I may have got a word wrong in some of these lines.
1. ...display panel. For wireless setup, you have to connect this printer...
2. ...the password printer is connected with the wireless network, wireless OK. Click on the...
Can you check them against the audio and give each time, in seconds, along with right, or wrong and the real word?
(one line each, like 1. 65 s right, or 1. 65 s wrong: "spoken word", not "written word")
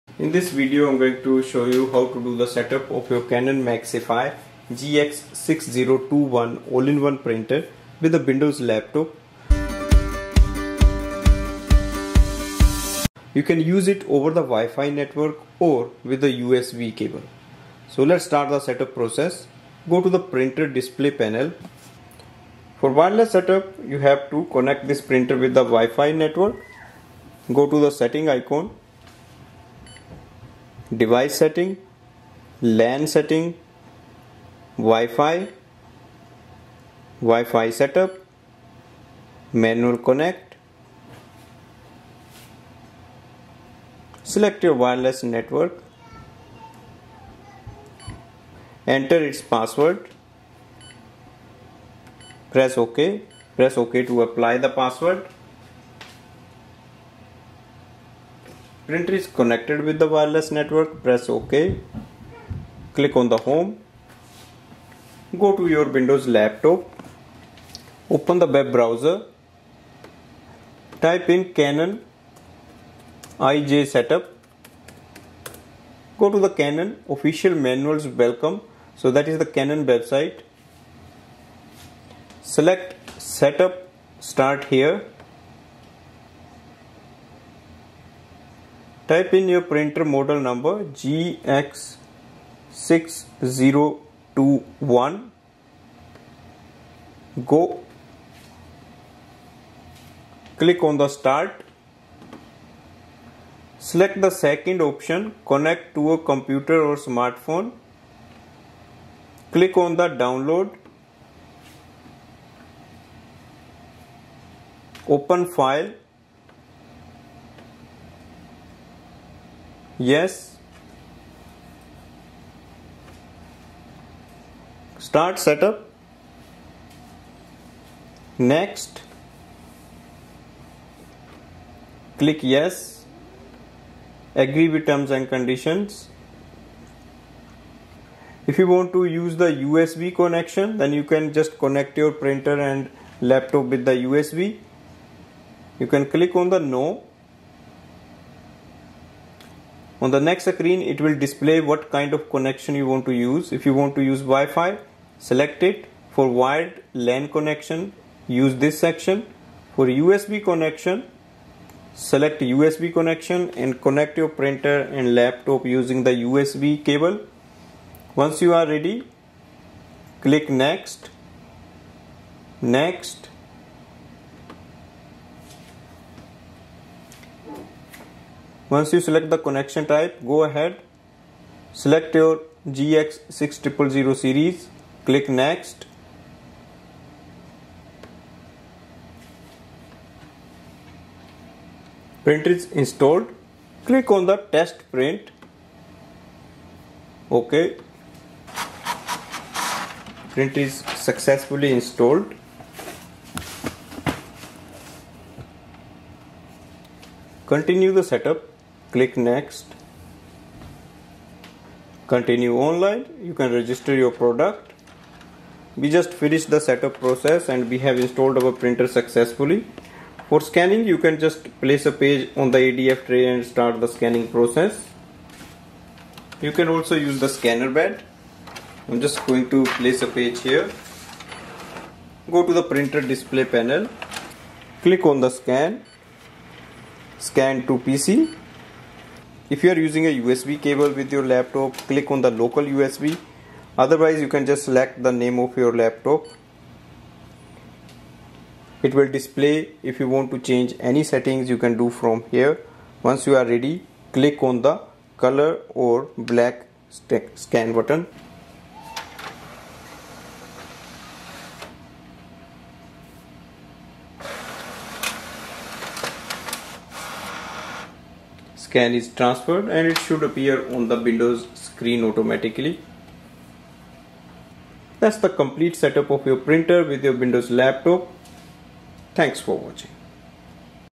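1. 20 s right
2. 54 s wrong: "press", not "wireless".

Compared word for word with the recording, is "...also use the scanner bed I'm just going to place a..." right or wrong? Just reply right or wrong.
right.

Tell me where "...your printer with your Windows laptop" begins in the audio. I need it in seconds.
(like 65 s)
276 s.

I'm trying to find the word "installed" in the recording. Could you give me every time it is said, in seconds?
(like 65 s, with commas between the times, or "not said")
192 s, 201 s, 217 s.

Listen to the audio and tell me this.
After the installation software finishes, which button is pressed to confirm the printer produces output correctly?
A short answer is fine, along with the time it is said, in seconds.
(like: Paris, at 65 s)
Test print, at 194 s.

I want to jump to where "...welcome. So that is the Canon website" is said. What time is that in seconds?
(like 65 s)
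78 s.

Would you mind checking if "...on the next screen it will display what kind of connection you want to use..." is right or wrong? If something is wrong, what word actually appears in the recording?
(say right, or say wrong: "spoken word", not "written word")
right.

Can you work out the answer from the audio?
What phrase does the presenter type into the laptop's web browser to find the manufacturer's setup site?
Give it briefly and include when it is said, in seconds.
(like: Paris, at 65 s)
Canon IJ setup, at 71 s.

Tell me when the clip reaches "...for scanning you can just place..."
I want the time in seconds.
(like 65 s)
220 s.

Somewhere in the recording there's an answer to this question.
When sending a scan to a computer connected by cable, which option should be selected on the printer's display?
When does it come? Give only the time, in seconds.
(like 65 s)
242 s.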